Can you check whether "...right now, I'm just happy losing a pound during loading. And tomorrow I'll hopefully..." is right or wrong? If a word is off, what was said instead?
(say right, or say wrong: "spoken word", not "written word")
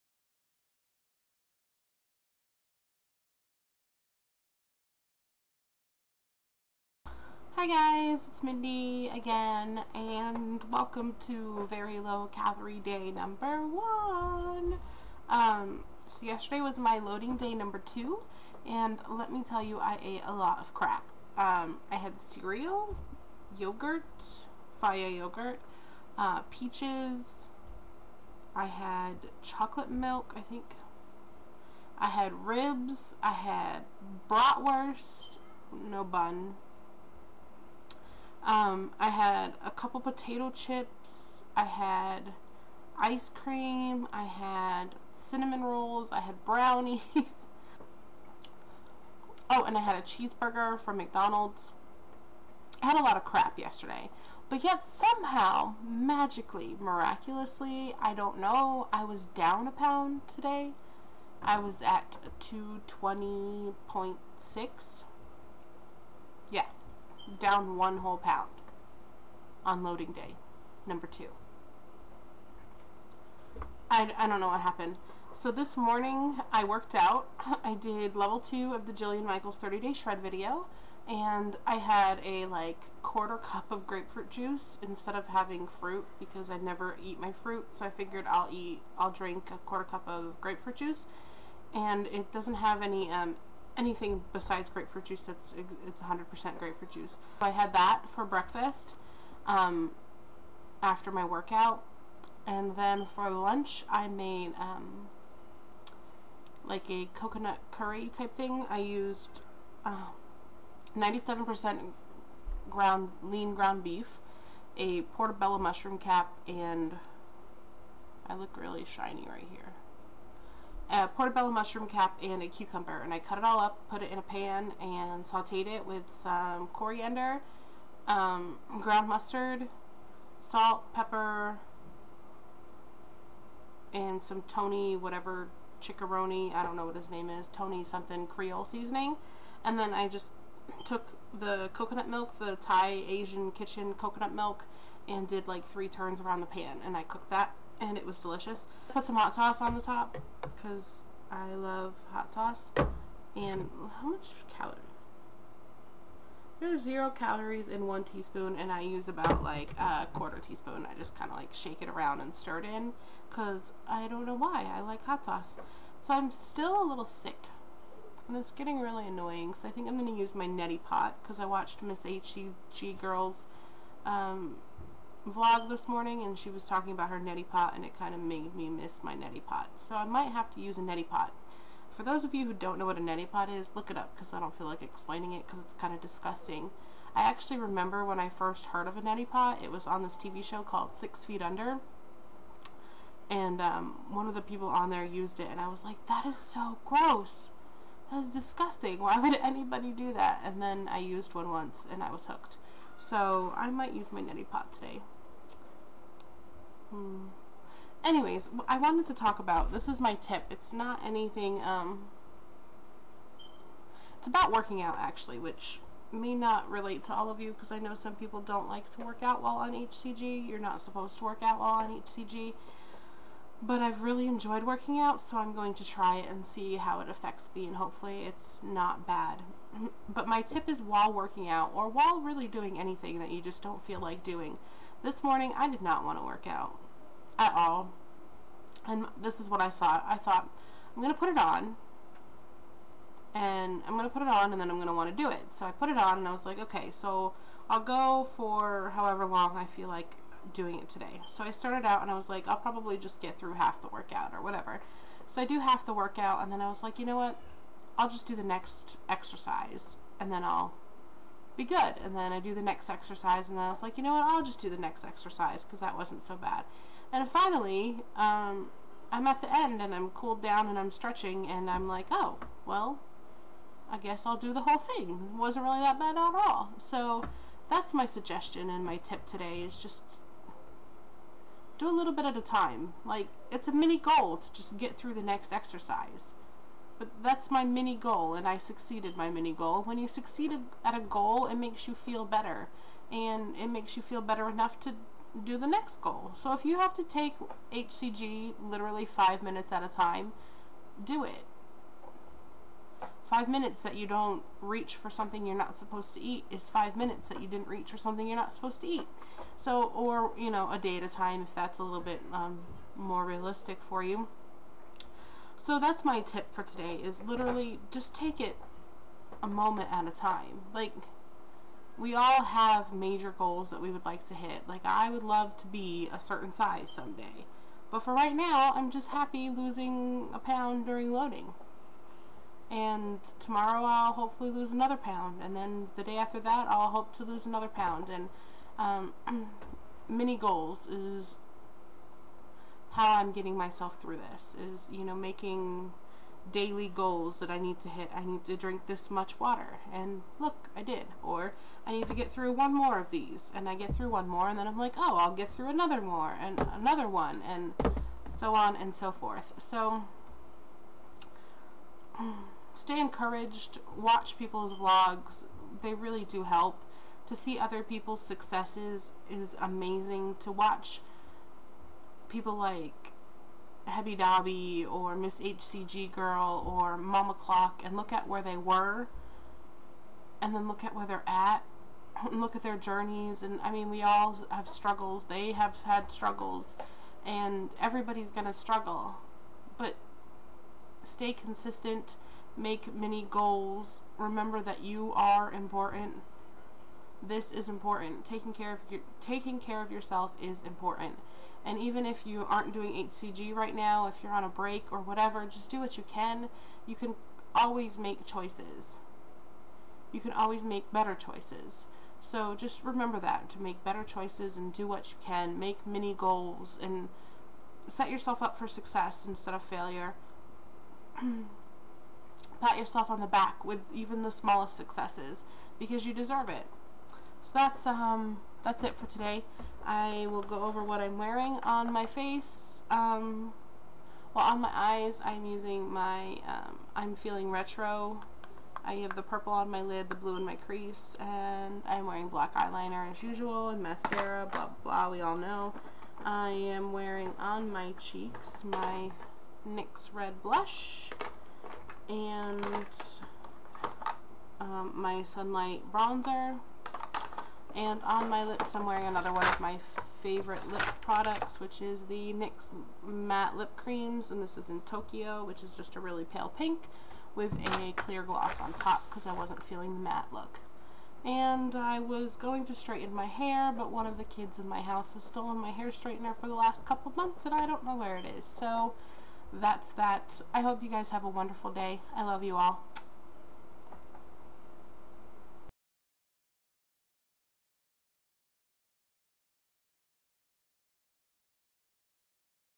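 right.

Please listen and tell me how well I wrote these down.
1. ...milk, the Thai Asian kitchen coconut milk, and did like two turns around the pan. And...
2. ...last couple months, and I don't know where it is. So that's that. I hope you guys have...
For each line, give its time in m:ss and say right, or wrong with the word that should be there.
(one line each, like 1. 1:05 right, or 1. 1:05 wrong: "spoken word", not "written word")
1. 2:22 wrong: "three", not "two"
2. 7:56 right.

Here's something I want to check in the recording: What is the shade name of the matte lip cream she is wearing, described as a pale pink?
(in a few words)
Tokyo.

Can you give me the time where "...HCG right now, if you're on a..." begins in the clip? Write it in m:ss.
6:42.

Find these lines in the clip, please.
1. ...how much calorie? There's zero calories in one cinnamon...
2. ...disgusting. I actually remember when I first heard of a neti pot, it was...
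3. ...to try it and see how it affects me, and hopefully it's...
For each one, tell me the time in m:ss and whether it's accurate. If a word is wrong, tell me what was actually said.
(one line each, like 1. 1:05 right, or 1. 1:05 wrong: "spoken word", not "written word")
1. 2:33 wrong: "teaspoon", not "cinnamon"
2. 3:06 right
3. 3:45 right.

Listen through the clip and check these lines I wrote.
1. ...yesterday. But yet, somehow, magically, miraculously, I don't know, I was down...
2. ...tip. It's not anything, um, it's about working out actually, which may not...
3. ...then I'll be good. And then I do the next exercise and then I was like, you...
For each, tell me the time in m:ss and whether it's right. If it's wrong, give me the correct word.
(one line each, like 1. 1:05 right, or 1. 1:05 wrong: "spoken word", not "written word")
1. 0:53 right
2. 3:30 right
3. 4:20 right.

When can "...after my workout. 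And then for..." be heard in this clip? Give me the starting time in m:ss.
1:40.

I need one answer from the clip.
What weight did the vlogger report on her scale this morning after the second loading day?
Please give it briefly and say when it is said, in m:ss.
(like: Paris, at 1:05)
220.6, at 1:02.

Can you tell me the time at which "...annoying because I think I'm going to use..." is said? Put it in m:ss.
2:49.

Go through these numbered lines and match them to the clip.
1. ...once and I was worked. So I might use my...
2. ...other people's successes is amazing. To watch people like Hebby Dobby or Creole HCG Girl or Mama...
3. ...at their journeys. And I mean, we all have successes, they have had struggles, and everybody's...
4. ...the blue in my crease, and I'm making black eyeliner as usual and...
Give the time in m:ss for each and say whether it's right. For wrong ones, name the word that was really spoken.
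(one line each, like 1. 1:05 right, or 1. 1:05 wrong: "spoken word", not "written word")
1. 3:21 wrong: "hooked", not "worked"
2. 6:07 wrong: "Miss", not "Creole"
3. 6:22 wrong: "struggles", not "successes"
4. 7:20 wrong: "wearing", not "making".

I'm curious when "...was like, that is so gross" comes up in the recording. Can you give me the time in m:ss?
3:15.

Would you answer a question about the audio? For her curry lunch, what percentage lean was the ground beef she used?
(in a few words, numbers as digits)
97%.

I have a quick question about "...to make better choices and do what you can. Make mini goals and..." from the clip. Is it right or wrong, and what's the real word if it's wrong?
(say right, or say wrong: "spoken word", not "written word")
right.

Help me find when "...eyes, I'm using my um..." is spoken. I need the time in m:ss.
7:14.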